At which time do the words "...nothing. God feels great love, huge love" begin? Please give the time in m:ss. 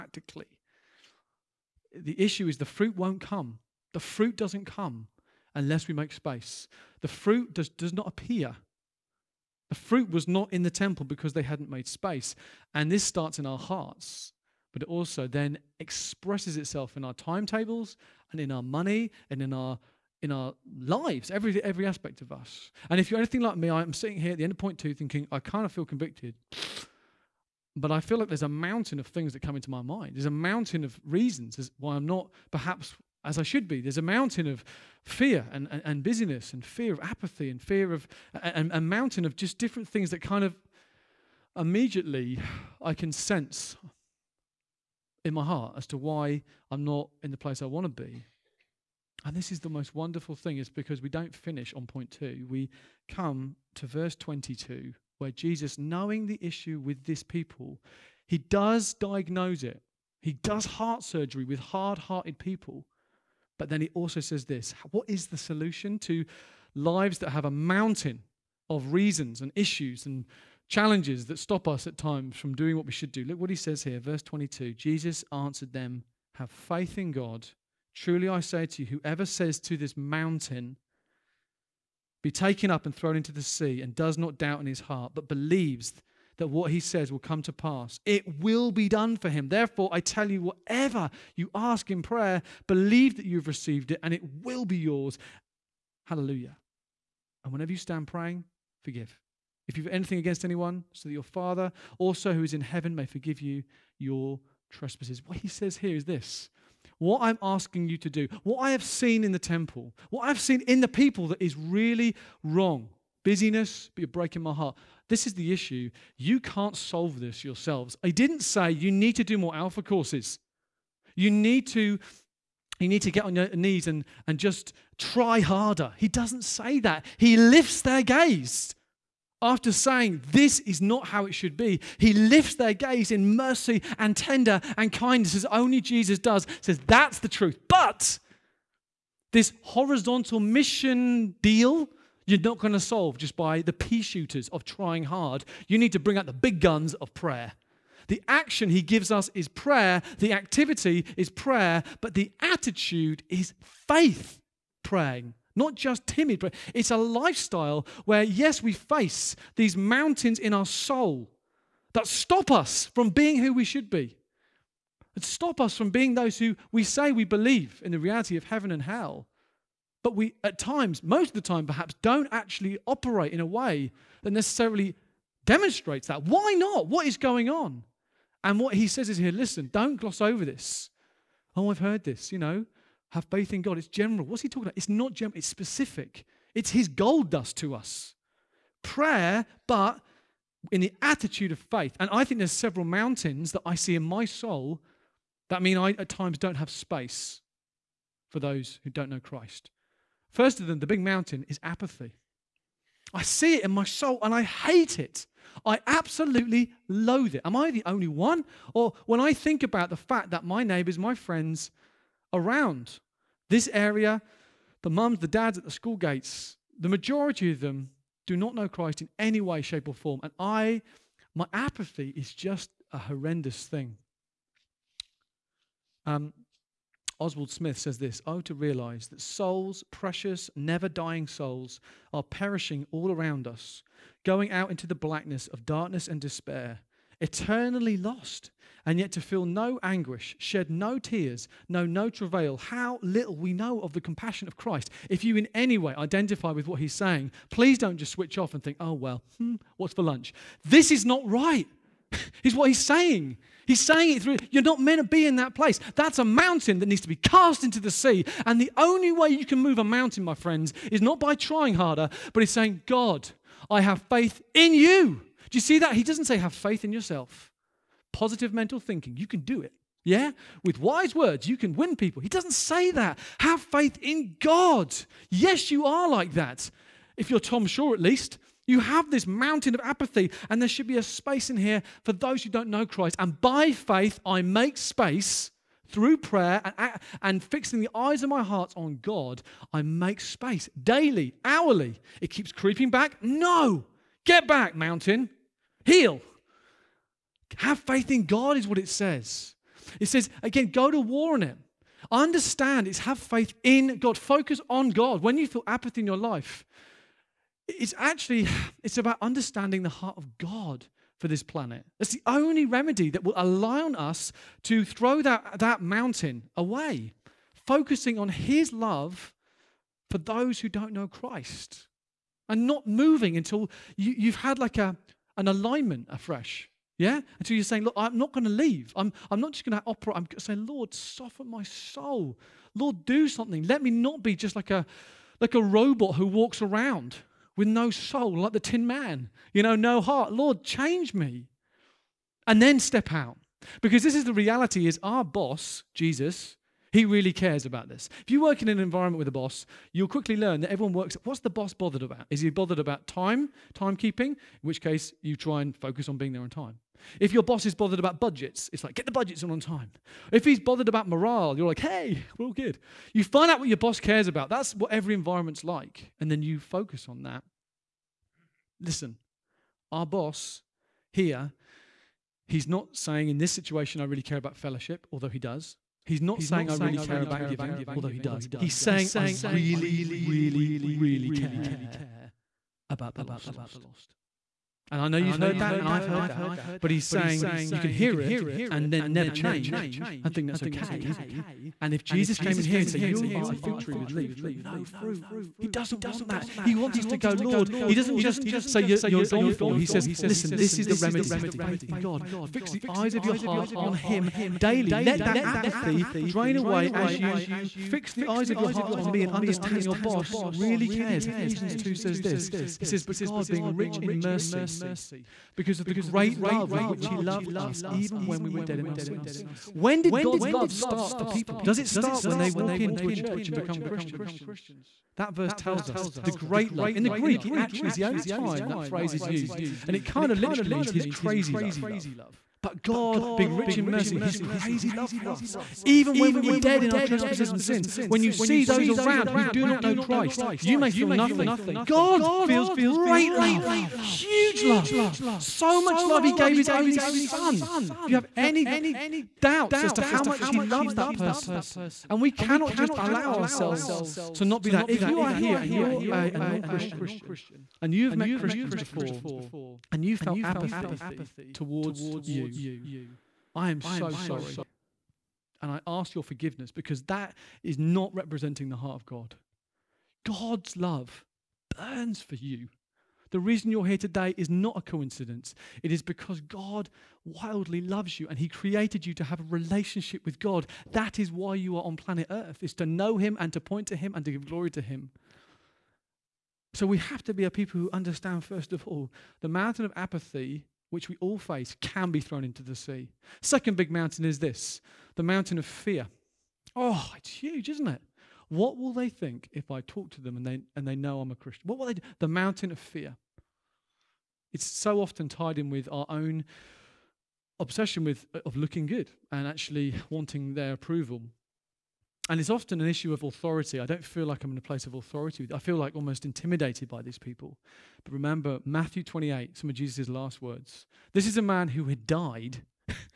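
7:21.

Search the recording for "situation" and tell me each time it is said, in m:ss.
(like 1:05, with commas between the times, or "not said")
6:13.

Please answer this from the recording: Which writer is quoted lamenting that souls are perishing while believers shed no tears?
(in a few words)
Oswald Smith.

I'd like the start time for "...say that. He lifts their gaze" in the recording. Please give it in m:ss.
2:06.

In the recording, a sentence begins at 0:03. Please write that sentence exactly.
The fruit doesn't come unless we make space.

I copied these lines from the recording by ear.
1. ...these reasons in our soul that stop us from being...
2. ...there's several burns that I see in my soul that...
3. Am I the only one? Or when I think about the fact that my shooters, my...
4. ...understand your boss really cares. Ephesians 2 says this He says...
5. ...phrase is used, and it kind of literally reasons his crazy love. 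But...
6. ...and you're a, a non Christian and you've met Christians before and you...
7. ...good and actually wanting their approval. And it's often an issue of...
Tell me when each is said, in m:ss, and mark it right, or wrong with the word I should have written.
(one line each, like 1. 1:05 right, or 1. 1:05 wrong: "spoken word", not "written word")
1. 2:39 wrong: "mountains", not "reasons"
2. 3:12 wrong: "mountains", not "burns"
3. 3:27 wrong: "neighbors", not "shooters"
4. 6:49 right
5. 7:08 wrong: "means", not "reasons"
6. 7:35 right
7. 8:28 right.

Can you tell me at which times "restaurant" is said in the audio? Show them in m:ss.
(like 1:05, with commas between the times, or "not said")
not said.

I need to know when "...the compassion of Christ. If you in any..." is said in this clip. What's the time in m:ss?
4:03.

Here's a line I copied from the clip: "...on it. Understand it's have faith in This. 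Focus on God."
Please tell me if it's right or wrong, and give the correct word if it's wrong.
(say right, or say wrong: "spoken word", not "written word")
wrong: "God", not "This".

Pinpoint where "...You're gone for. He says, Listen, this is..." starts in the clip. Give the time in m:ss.
6:38.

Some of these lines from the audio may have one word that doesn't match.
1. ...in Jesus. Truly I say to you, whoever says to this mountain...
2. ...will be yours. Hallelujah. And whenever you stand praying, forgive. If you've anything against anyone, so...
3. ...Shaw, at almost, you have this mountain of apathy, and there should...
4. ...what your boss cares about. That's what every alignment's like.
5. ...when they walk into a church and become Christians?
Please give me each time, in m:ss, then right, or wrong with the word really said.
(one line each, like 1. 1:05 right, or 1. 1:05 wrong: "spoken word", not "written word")
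1. 1:16 wrong: "God", not "Jesus"
2. 1:34 right
3. 4:37 wrong: "least", not "almost"
4. 6:03 wrong: "environment", not "alignment"
5. 7:02 right.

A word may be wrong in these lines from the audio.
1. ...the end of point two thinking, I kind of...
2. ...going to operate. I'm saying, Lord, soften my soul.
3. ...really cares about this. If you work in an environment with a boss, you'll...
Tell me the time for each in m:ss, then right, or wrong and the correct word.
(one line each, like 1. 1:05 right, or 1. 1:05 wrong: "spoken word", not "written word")
1. 0:24 right
2. 5:29 right
3. 5:47 right.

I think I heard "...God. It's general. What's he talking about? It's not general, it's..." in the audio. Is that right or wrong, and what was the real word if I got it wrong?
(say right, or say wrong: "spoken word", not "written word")
right.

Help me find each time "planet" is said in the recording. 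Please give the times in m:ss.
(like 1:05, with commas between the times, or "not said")
5:11, 8:01.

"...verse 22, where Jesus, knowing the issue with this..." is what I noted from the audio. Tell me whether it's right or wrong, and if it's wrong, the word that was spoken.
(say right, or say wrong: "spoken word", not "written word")
right.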